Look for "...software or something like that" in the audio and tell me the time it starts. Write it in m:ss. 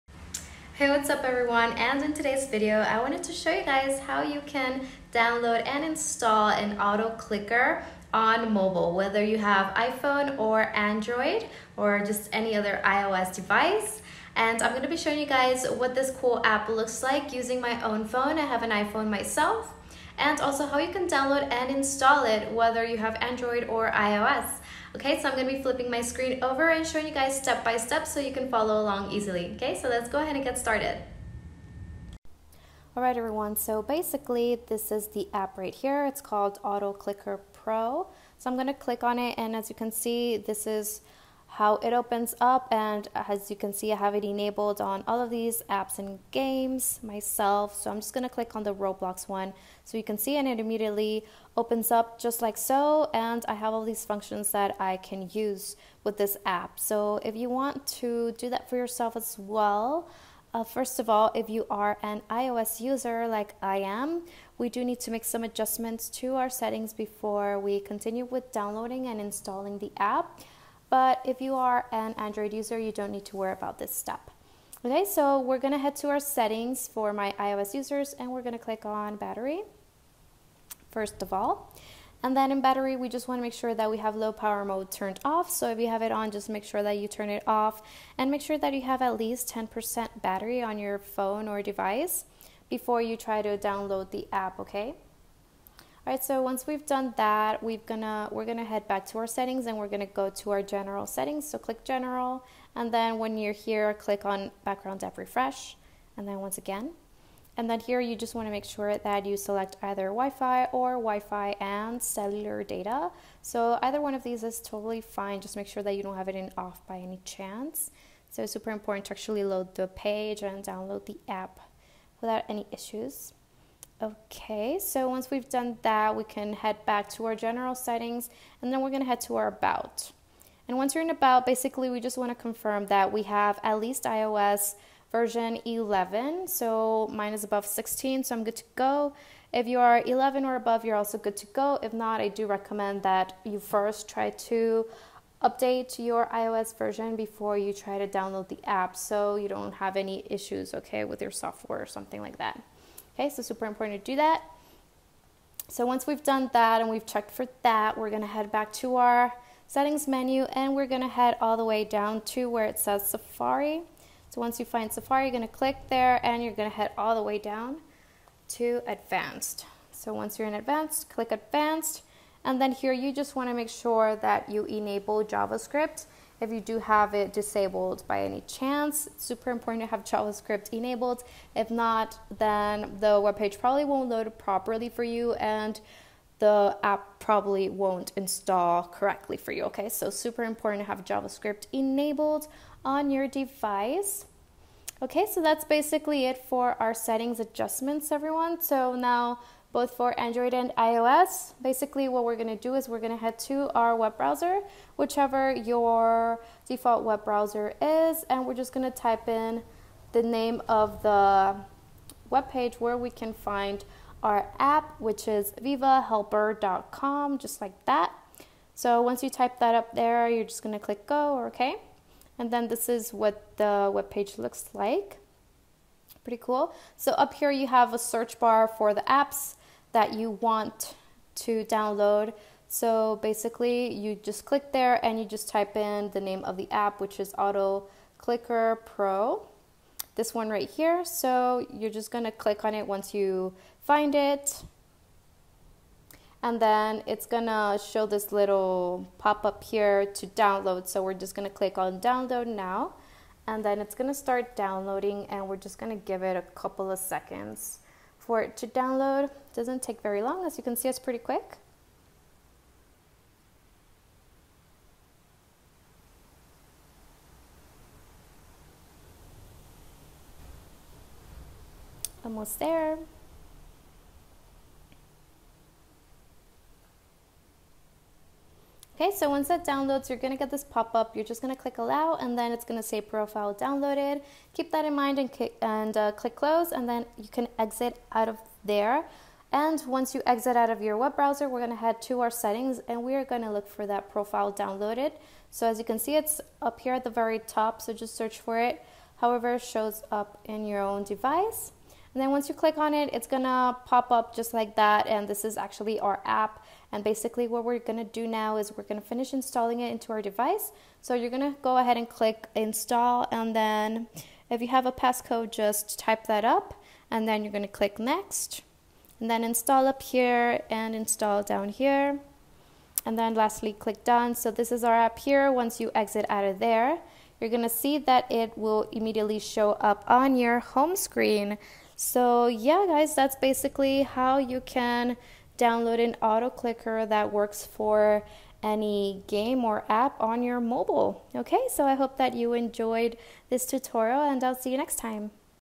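2:31.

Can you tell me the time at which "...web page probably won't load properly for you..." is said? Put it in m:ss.
3:03.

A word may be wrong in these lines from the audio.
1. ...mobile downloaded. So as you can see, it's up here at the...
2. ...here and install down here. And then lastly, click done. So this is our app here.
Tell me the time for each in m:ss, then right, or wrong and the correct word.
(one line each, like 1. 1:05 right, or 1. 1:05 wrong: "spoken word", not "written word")
1. 4:54 wrong: "profile", not "mobile"
2. 5:20 right.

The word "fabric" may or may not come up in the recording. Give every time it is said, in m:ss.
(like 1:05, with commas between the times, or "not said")
not said.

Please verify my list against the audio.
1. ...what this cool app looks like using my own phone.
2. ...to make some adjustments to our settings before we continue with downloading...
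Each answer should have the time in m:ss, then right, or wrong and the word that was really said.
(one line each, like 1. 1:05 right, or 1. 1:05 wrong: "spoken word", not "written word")
1. 0:15 right
2. 1:04 right.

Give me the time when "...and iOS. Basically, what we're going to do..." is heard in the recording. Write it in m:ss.
3:20.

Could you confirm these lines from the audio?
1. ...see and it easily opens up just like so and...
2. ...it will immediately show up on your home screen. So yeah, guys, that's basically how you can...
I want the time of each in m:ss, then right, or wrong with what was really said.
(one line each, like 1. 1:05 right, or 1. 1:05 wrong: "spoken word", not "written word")
1. 0:50 wrong: "immediately", not "easily"
2. 5:28 right.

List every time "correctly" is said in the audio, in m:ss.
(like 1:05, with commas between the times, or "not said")
3:08.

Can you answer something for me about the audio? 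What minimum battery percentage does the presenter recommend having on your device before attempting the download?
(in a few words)
10%.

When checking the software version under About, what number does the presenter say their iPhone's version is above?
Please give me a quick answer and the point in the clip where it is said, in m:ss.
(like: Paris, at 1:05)
16, at 2:17.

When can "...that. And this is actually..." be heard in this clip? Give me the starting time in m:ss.
5:04.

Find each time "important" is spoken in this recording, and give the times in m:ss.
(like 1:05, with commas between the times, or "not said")
1:58, 2:33, 2:59, 3:10.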